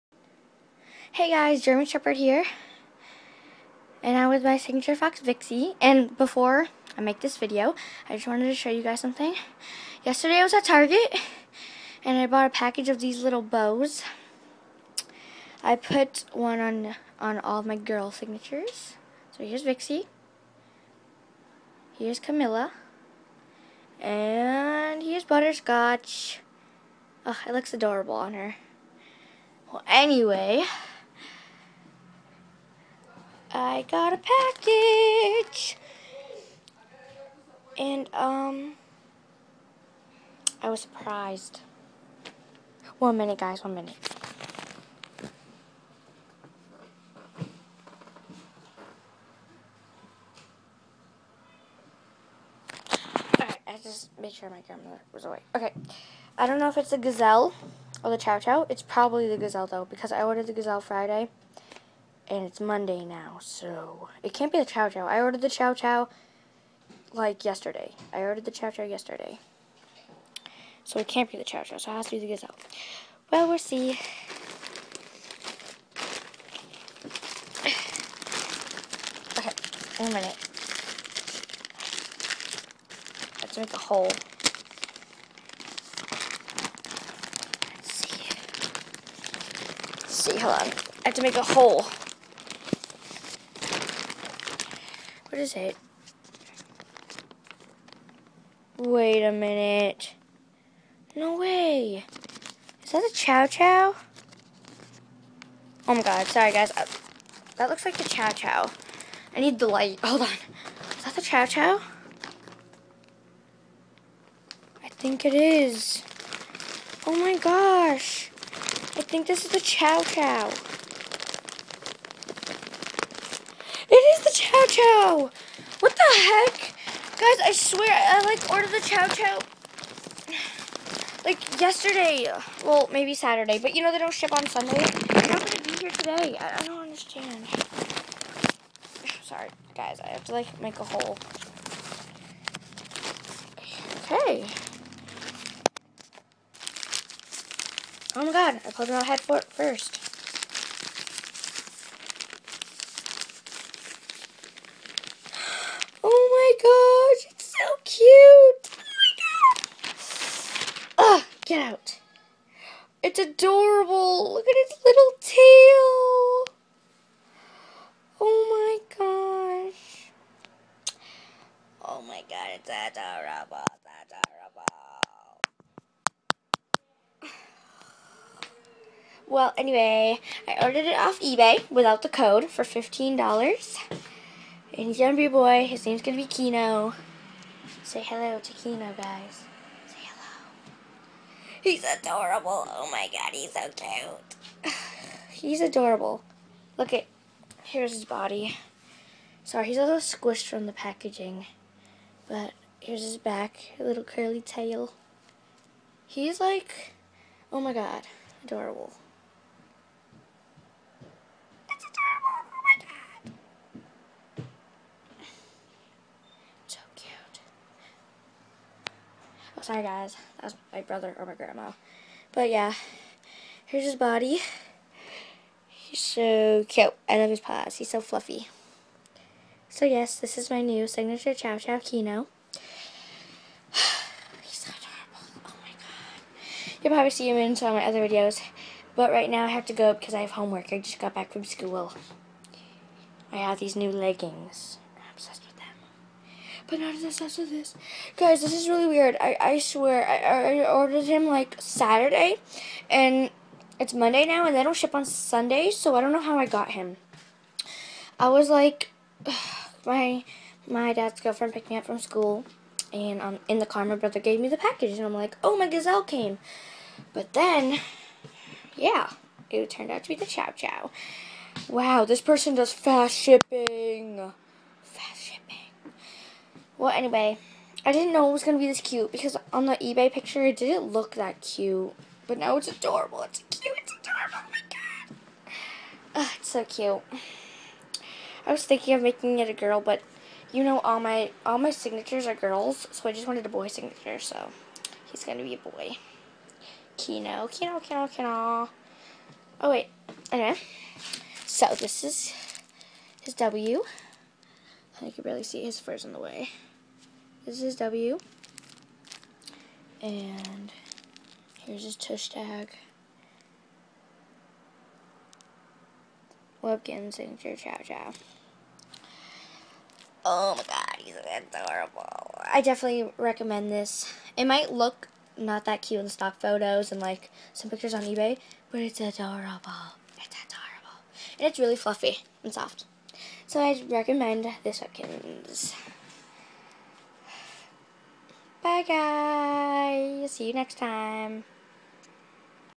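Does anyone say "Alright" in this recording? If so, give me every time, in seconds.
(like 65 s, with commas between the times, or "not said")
53 s.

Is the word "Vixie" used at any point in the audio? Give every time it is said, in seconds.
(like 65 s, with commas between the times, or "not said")
5 s, 19 s.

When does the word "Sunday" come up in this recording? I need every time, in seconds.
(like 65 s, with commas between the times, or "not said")
134 s, 255 s.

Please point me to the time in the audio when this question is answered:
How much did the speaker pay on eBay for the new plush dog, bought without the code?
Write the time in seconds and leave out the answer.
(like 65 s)
182 s.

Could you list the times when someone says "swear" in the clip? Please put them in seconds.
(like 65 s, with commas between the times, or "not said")
127 s, 249 s.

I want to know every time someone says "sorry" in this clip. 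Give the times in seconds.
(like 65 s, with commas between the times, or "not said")
106 s, 139 s, 199 s, 219 s.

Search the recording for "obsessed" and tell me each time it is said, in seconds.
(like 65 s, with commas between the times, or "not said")
247 s.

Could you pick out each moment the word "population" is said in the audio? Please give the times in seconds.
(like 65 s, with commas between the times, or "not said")
not said.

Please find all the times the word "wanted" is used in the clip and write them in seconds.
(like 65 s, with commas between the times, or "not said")
8 s, 293 s.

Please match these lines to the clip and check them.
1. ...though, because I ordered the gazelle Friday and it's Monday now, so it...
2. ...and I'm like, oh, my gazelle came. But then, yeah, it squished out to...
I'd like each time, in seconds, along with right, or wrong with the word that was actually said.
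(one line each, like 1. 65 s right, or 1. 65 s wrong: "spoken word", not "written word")
1. 59 s right
2. 264 s wrong: "turned", not "squished".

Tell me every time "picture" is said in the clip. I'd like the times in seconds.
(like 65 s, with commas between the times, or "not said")
280 s, 327 s.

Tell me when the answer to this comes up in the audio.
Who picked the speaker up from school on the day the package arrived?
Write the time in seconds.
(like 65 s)
260 s.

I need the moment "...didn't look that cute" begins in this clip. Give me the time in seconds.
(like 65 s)
280 s.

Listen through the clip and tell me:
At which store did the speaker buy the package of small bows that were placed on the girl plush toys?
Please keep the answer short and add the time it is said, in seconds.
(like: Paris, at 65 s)
Target, at 10 s.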